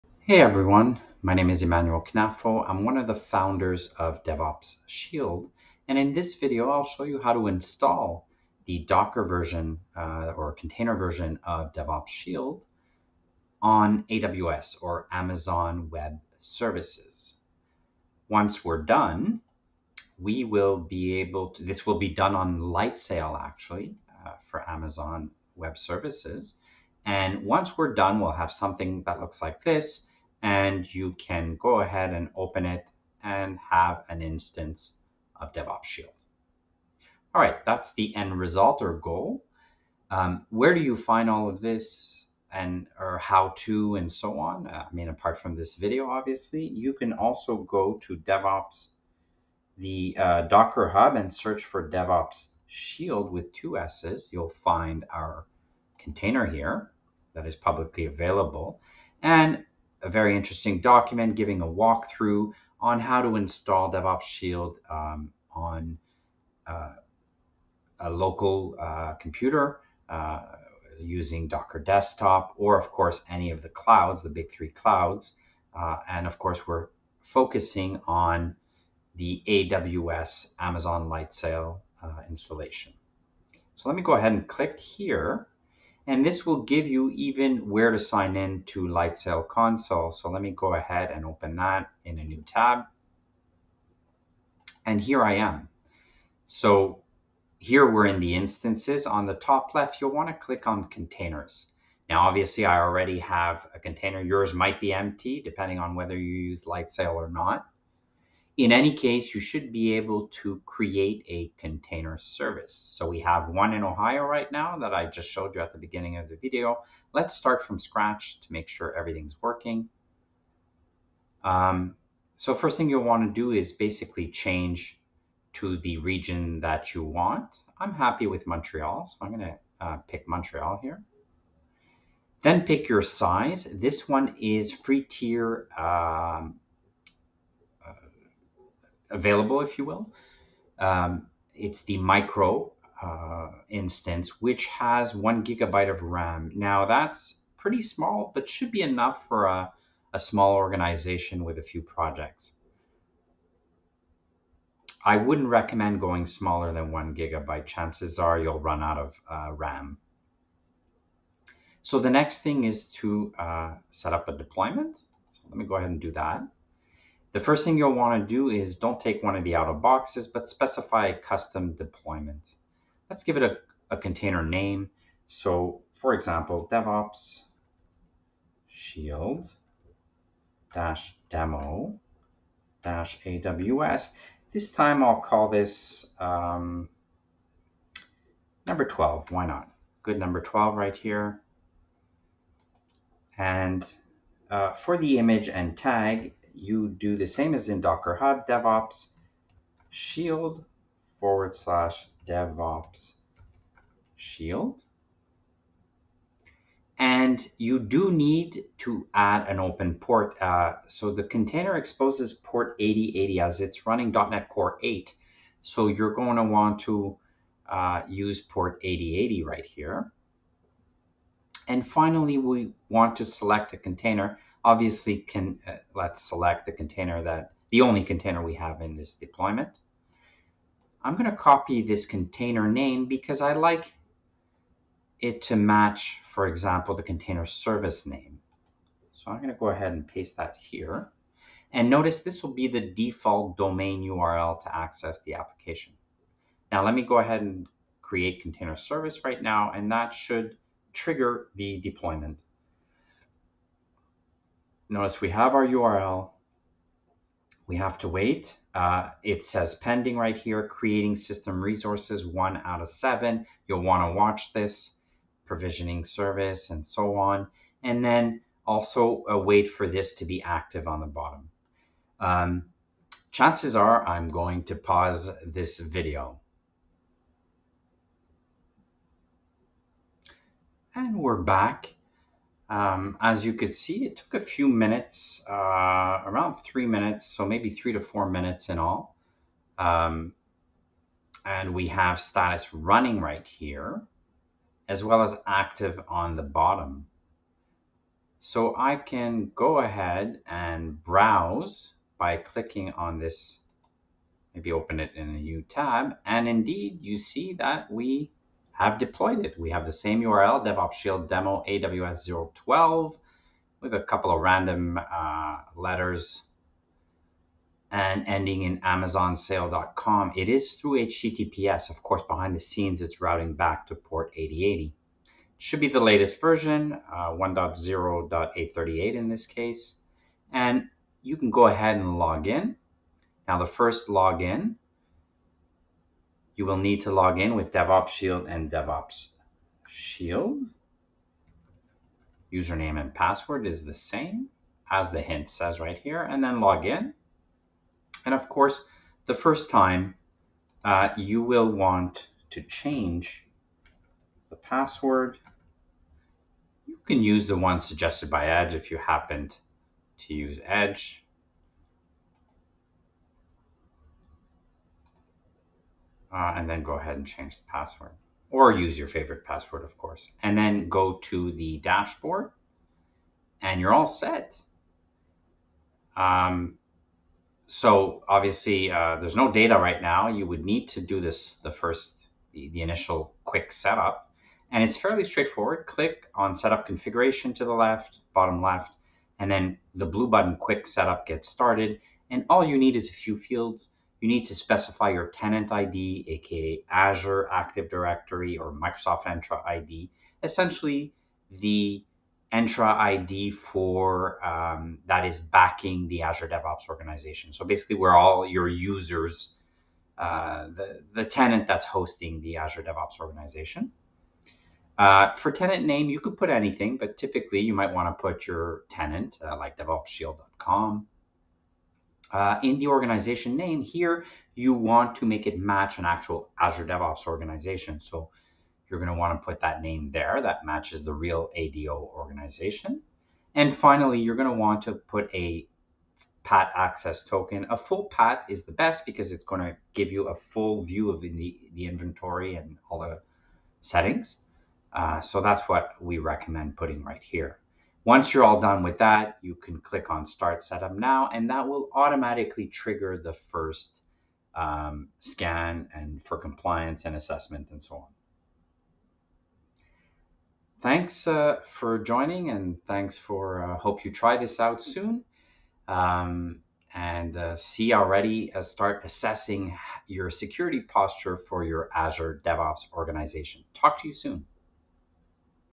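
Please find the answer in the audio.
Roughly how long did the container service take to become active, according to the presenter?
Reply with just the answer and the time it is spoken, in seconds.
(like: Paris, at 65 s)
around 3 minutes, at 286 s.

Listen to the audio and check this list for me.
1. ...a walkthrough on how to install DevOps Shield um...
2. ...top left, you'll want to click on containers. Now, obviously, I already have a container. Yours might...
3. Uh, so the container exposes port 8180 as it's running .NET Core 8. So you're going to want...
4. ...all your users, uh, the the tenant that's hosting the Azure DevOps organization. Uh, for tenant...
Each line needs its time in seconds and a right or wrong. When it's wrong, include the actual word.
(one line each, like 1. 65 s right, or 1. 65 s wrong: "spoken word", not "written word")
1. 61 s right
2. 99 s right
3. 210 s wrong: "8080", not "8180"
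4. 408 s right.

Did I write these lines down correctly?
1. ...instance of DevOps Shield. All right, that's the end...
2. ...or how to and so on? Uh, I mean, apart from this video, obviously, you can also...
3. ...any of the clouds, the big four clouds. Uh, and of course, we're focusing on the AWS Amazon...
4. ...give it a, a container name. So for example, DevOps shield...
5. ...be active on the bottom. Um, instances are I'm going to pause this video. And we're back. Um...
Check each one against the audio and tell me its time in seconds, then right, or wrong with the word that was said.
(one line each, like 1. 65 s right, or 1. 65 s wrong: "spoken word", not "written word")
1. 34 s right
2. 42 s right
3. 73 s wrong: "three", not "four"
4. 173 s right
5. 270 s wrong: "chances", not "instances".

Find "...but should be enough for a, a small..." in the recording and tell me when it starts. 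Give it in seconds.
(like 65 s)
148 s.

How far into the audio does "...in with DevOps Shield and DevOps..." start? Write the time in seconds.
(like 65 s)
337 s.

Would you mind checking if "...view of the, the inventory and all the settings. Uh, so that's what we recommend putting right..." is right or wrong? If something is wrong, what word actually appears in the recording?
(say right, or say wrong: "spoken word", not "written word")
right.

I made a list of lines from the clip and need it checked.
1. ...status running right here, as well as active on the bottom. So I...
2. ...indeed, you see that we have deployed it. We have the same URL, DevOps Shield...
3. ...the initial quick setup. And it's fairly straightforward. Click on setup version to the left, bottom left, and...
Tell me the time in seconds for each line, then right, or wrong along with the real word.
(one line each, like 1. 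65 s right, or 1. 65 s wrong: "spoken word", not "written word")
1. 292 s right
2. 306 s right
3. 382 s wrong: "configuration", not "version".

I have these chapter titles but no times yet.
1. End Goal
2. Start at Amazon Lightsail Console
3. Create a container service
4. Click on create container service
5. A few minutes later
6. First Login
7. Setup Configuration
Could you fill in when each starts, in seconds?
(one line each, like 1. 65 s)
1. 30 s
2. 90 s
3. 120 s
4. 246 s
5. 280 s
6. 330 s
7. 387 s.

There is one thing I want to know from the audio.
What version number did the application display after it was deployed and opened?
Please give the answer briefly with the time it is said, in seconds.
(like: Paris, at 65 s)
1.0.838, at 327 s.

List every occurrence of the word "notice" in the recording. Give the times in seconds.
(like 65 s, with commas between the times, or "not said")
241 s, 254 s.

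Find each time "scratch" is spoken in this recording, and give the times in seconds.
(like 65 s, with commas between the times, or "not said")
117 s.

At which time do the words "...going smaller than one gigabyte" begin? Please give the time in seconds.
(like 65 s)
155 s.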